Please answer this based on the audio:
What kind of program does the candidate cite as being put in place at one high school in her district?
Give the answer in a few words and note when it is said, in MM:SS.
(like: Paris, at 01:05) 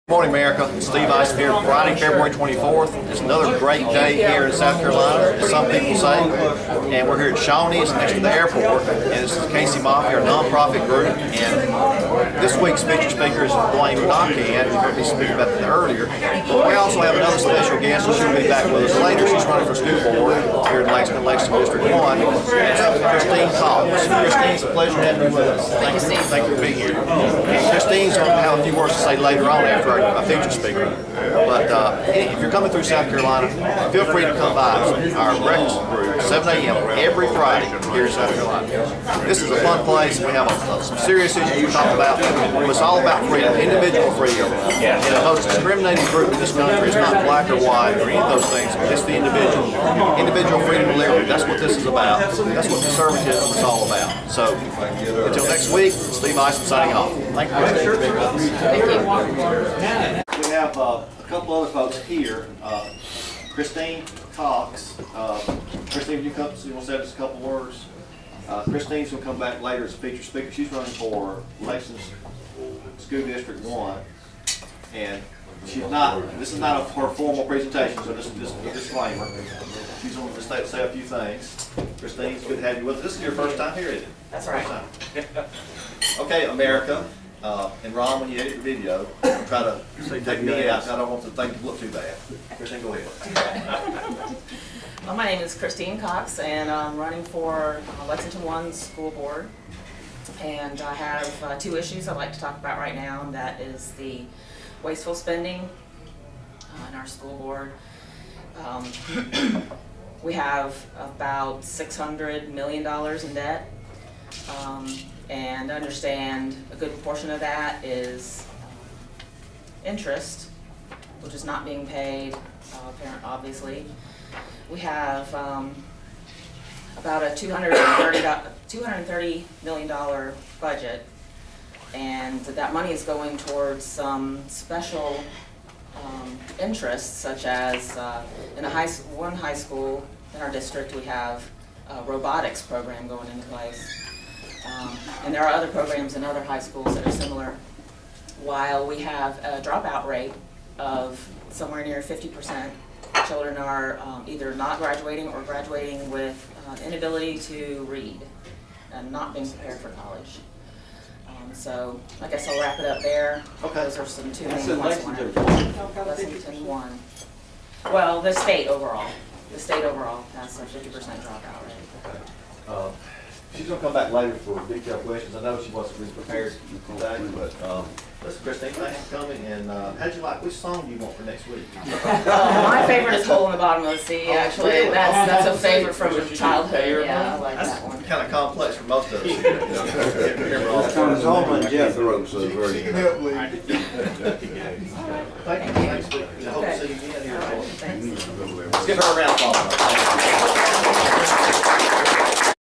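robotics program, at 02:22.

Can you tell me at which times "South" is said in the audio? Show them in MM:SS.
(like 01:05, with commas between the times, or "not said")
00:04, 00:32, 00:38.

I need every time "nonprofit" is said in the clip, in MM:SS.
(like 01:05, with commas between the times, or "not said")
00:10.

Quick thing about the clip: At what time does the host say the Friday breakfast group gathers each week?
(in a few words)
7 a.m.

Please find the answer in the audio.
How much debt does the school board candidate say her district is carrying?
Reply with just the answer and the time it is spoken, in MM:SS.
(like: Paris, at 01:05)
$600 million, at 01:51.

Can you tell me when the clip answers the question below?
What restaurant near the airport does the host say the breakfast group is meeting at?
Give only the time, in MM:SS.
00:07.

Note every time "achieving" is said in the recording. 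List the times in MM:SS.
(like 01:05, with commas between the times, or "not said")
not said.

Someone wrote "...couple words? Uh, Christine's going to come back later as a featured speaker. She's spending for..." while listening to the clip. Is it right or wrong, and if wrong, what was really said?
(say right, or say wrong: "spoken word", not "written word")
wrong: "running", not "spending".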